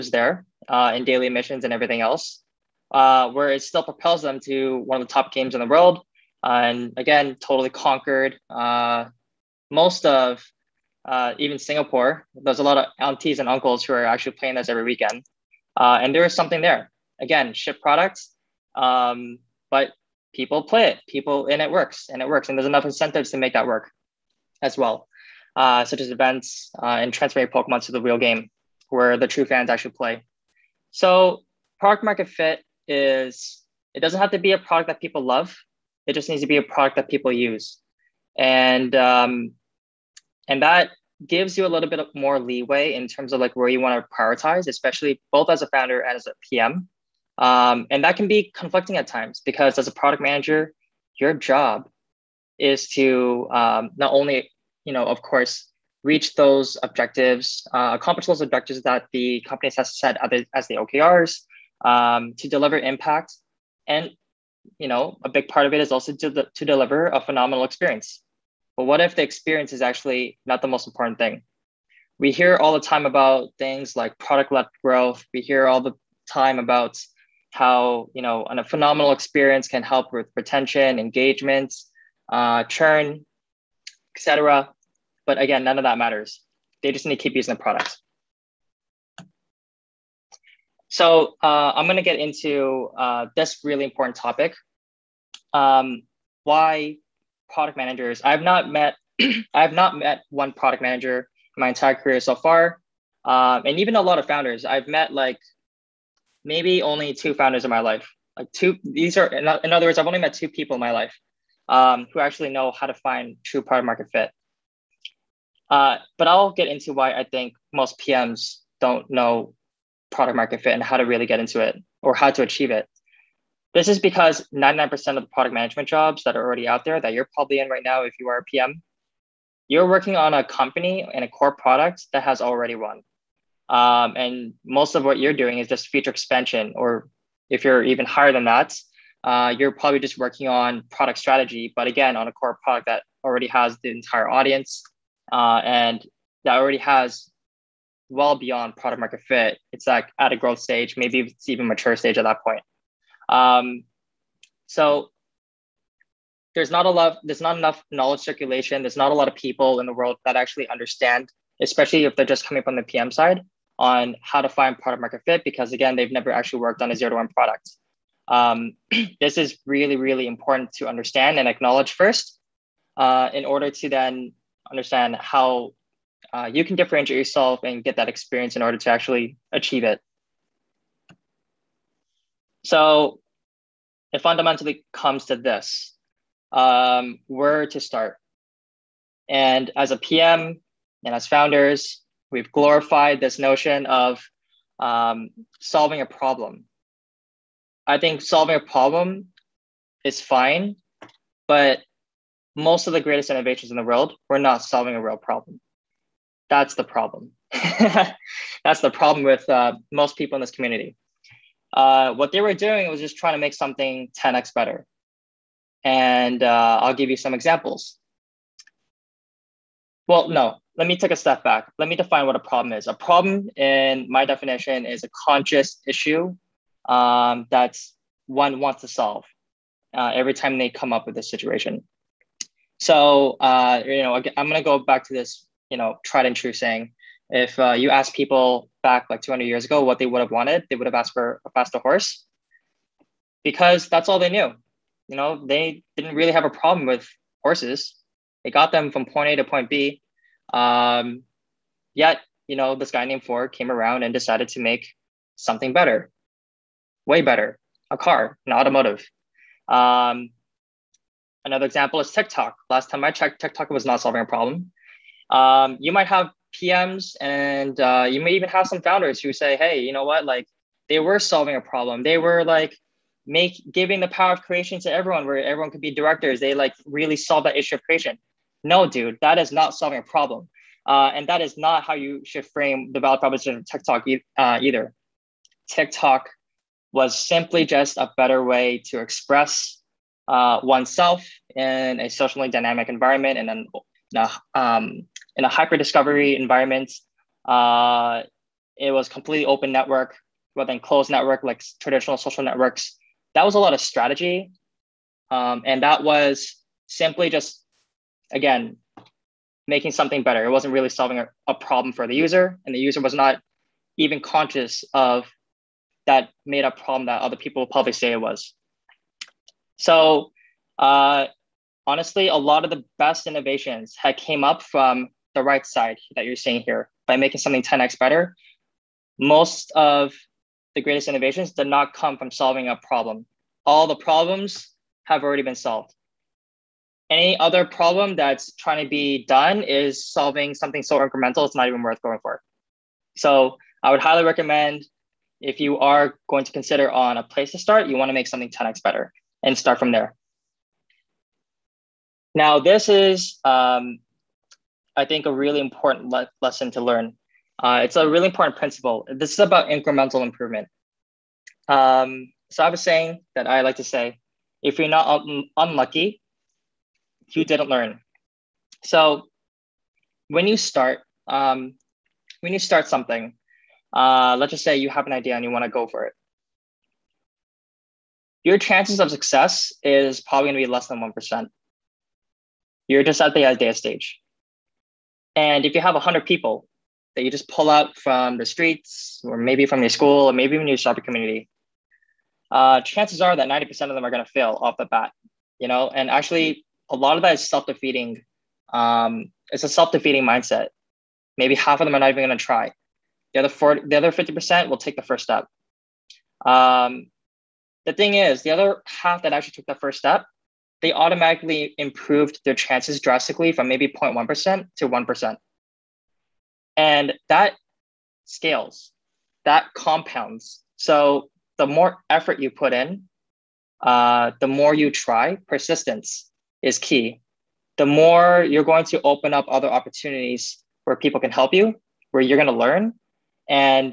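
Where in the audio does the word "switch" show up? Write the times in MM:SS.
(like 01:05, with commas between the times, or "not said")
not said.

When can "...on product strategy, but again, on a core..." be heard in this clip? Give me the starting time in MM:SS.
02:20.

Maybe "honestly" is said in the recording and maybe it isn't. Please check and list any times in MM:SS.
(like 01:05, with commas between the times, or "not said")
05:21.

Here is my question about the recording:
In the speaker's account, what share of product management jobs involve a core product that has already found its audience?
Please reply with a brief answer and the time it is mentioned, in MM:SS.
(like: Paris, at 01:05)
99%, at 02:04.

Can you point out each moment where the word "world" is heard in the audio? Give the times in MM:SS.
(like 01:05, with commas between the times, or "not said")
00:05, 02:39, 03:23.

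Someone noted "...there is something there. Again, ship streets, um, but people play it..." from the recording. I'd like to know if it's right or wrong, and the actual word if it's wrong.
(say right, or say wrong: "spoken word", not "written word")
wrong: "products", not "streets".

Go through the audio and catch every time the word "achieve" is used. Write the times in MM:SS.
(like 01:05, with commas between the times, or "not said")
02:02, 02:59.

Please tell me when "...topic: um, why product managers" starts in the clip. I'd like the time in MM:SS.
01:34.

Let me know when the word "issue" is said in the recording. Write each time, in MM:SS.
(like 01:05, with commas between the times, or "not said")
03:45, 04:37.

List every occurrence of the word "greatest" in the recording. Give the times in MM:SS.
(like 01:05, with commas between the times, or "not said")
03:22, 05:30.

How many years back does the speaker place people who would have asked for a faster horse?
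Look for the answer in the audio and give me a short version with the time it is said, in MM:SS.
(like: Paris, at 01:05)
200, at 03:59.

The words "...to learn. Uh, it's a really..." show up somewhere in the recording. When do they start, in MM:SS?
05:56.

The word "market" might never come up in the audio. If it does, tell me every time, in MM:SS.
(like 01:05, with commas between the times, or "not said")
00:32, 01:53, 02:00, 02:29, 02:45.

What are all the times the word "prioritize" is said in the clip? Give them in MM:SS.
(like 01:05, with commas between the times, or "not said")
00:44.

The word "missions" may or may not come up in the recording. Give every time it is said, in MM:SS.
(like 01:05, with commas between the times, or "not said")
00:01.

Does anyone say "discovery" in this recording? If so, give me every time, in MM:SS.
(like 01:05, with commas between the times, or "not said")
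04:55.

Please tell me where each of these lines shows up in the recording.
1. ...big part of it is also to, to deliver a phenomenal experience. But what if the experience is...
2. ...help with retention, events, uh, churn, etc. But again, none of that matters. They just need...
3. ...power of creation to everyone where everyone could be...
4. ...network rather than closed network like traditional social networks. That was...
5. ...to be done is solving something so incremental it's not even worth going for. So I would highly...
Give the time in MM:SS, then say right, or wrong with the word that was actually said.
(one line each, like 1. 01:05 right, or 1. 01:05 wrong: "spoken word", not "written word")
1. 01:05 right
2. 01:19 wrong: "engagements", not "events"
3. 04:34 right
4. 04:59 right
5. 05:38 right.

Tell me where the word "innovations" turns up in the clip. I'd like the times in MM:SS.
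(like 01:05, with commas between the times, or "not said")
03:23, 05:23, 05:31.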